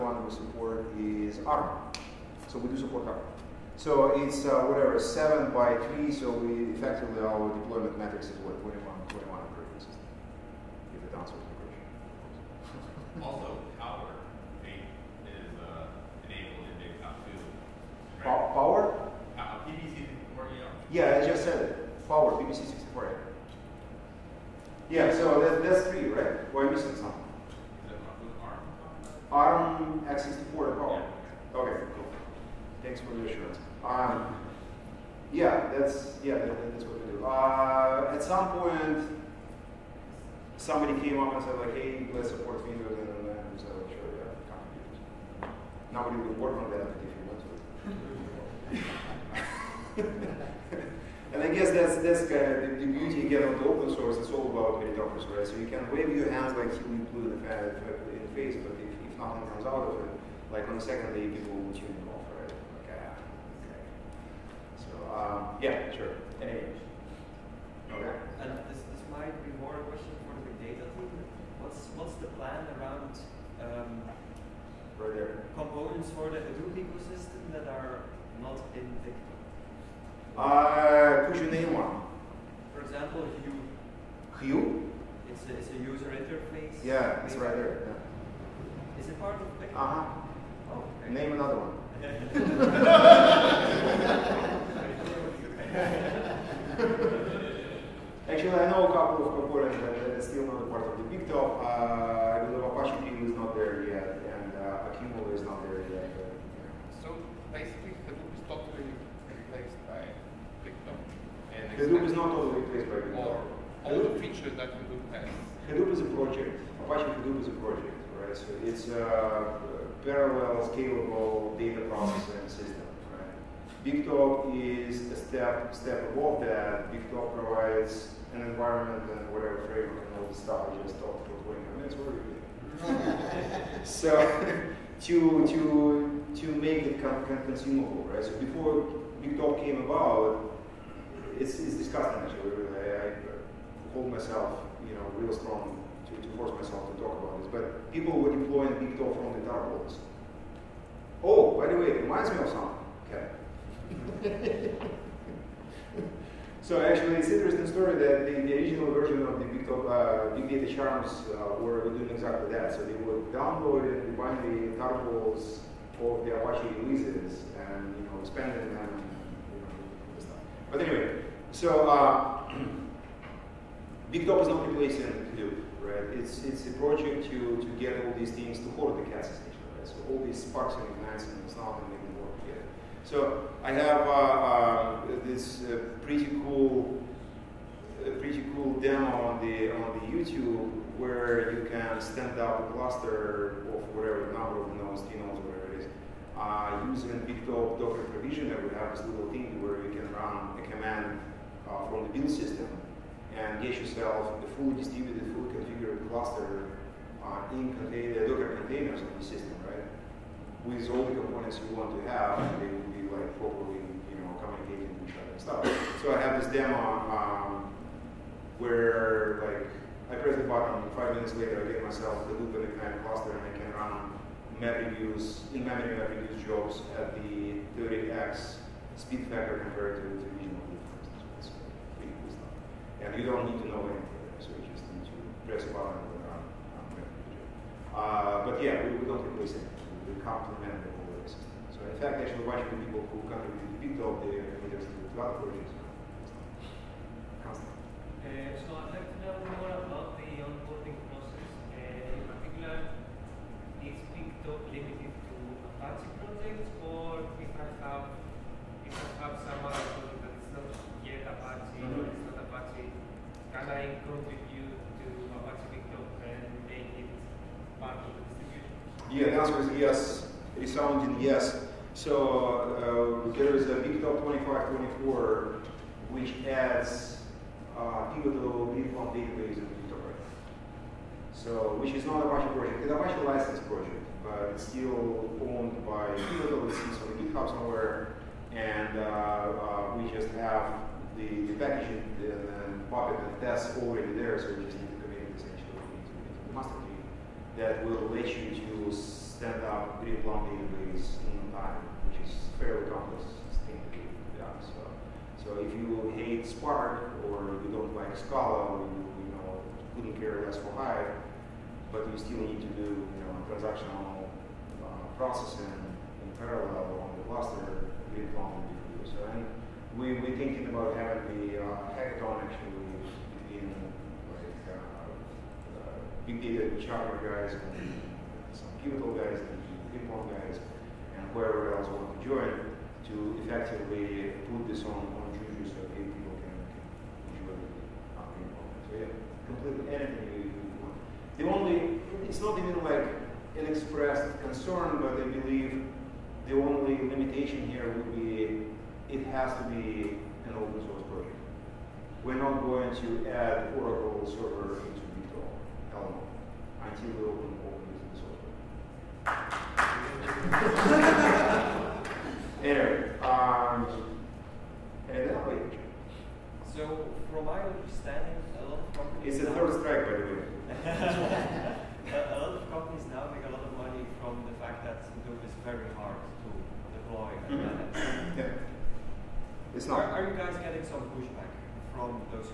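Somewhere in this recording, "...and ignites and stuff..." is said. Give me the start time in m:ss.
3:00.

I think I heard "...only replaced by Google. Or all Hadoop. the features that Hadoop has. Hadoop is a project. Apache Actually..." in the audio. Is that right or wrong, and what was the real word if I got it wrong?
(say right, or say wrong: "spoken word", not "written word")
wrong: "Hadoop", not "Actually".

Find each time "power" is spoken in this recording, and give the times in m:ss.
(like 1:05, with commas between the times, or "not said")
0:13, 0:18, 0:30.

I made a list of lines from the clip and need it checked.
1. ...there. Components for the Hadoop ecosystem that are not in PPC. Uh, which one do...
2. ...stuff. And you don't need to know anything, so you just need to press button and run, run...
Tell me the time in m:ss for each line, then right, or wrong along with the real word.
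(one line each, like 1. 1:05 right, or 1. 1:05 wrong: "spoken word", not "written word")
1. 1:15 wrong: "Victor", not "PPC"
2. 3:52 right.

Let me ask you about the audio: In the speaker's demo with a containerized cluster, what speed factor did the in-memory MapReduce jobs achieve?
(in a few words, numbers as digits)
30x.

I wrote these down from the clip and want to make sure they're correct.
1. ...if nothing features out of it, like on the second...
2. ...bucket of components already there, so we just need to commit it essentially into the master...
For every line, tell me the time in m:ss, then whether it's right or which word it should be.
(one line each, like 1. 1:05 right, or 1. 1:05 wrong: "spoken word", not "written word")
1. 0:58 wrong: "comes", not "features"
2. 4:52 wrong: "tests", not "components".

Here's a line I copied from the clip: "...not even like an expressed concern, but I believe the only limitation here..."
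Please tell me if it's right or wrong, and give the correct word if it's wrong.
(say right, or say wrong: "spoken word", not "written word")
right.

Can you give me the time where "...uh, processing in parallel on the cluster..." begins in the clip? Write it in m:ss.
5:14.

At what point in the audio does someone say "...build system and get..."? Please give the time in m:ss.
3:22.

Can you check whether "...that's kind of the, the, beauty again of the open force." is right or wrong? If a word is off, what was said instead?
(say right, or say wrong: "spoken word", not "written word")
wrong: "source", not "force".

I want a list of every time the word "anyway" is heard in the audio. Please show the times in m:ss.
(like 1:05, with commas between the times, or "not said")
1:06, 2:50.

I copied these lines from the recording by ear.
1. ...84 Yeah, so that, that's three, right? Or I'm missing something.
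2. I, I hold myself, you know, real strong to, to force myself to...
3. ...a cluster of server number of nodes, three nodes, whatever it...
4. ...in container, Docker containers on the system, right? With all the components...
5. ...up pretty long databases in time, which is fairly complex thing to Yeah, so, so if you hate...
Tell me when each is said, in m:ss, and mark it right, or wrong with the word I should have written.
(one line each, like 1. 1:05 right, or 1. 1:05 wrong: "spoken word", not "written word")
1. 0:22 wrong: "64", not "84"
2. 2:22 right
3. 3:12 wrong: "whatever", not "server"
4. 3:27 right
5. 4:59 right.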